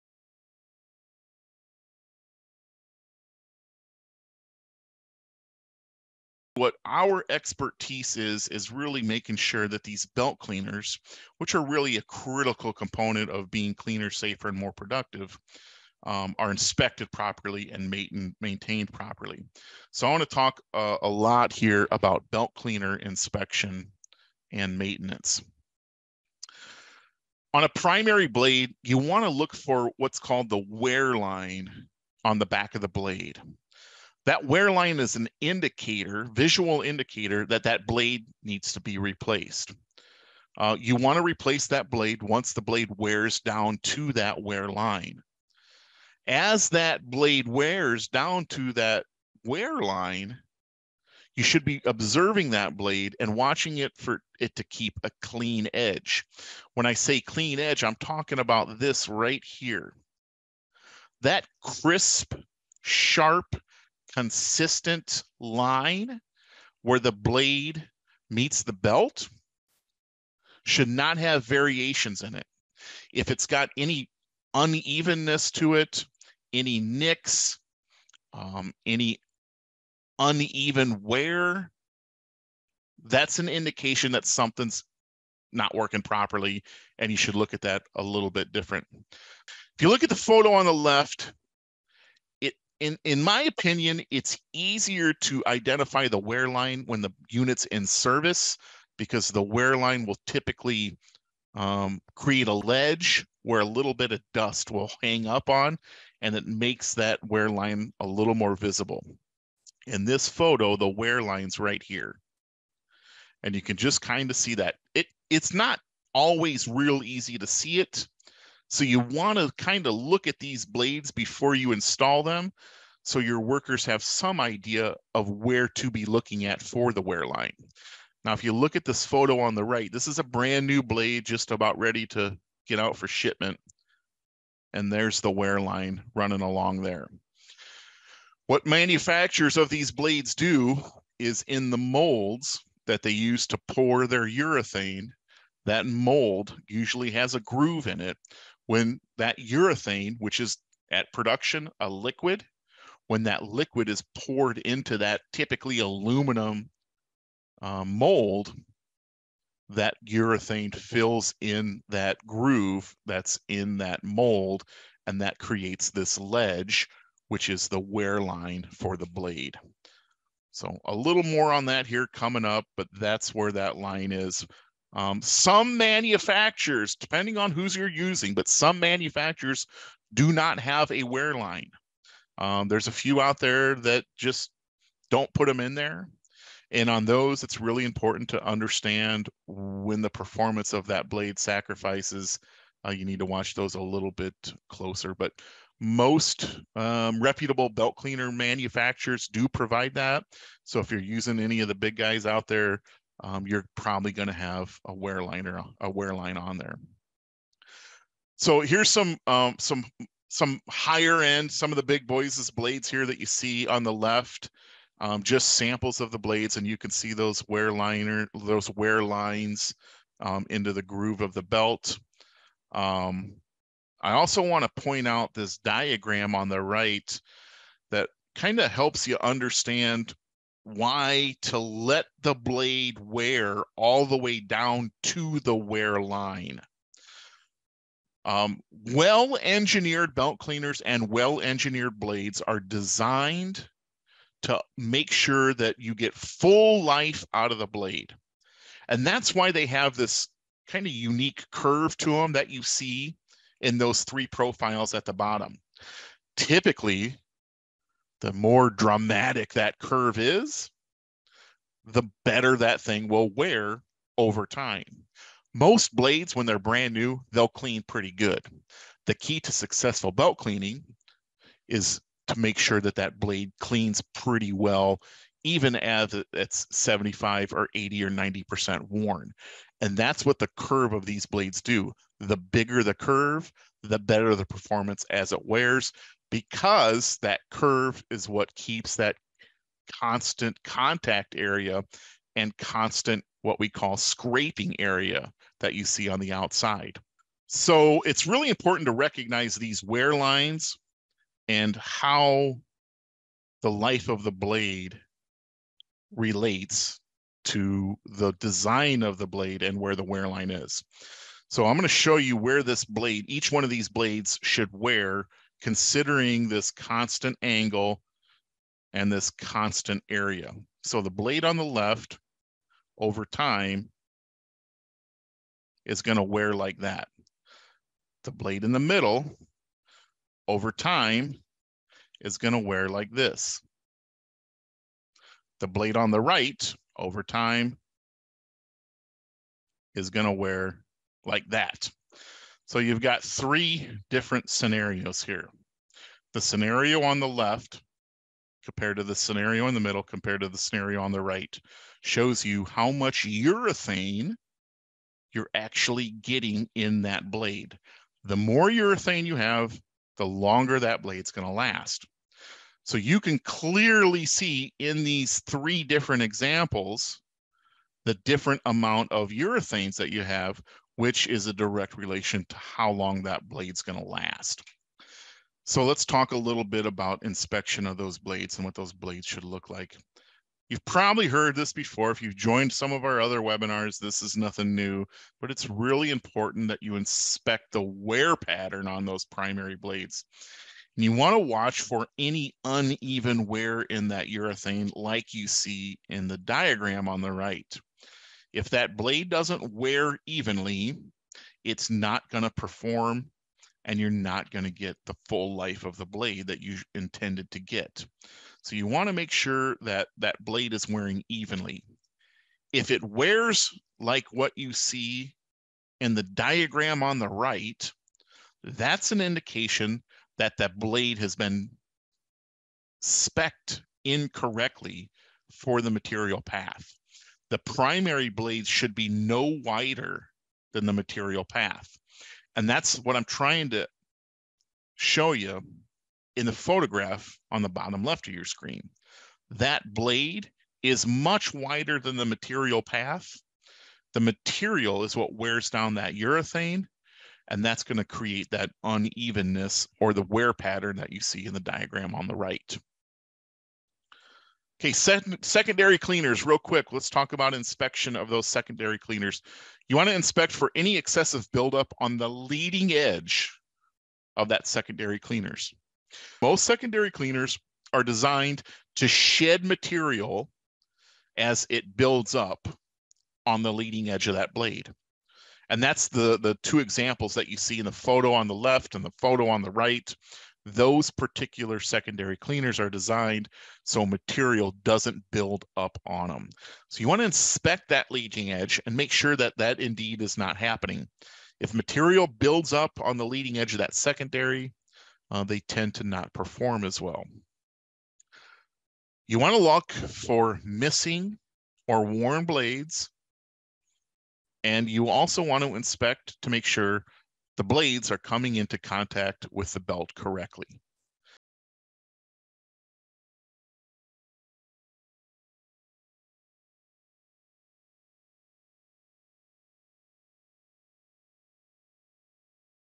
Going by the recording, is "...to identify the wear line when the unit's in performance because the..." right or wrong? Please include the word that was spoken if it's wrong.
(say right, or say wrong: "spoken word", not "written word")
wrong: "service", not "performance".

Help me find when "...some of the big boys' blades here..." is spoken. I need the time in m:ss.
3:31.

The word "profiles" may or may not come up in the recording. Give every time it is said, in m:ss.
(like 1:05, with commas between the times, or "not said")
4:14.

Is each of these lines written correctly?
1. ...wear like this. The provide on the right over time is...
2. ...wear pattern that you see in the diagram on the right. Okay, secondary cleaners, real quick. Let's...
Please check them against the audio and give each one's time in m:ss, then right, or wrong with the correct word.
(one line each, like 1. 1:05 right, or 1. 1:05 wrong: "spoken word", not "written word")
1. 5:32 wrong: "blade", not "provide"
2. 7:30 right.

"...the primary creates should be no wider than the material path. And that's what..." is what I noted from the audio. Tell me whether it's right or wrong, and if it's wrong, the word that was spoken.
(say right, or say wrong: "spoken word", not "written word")
wrong: "blades", not "creates".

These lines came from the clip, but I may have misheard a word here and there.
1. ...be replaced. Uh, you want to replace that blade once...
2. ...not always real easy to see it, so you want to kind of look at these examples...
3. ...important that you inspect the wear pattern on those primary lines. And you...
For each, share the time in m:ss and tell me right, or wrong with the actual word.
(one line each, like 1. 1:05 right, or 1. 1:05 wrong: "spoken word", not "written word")
1. 0:38 right
2. 1:55 wrong: "blades", not "examples"
3. 6:26 wrong: "blades", not "lines".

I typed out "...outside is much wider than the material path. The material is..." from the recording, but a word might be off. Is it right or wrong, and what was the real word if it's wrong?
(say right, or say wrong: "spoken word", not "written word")
wrong: "blade", not "outside".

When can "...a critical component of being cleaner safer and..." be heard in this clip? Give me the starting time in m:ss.
0:11.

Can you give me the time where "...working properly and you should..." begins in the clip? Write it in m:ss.
1:25.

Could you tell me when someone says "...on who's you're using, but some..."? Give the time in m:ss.
2:57.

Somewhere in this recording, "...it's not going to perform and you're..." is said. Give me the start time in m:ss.
6:41.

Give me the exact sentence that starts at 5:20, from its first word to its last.
So the blade on the left over time is going to wear like that.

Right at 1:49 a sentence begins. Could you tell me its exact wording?
In this photo, the wear line's right here.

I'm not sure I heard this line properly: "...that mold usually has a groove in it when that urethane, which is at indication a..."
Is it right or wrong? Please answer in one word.
wrong.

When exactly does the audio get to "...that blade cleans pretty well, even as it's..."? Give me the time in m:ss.
4:32.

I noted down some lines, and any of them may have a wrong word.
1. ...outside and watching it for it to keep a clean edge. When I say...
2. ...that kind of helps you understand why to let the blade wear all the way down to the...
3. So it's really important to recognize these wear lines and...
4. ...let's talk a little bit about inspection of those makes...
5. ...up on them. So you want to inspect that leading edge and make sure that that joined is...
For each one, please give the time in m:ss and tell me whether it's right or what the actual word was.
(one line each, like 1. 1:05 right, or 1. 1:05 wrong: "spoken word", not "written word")
1. 0:52 wrong: "blade", not "outside"
2. 3:47 right
3. 4:57 right
4. 6:15 wrong: "blades", not "makes"
5. 8:05 wrong: "indeed", not "joined".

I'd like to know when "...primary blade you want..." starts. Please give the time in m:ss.
0:27.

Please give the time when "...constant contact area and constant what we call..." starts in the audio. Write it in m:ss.
4:49.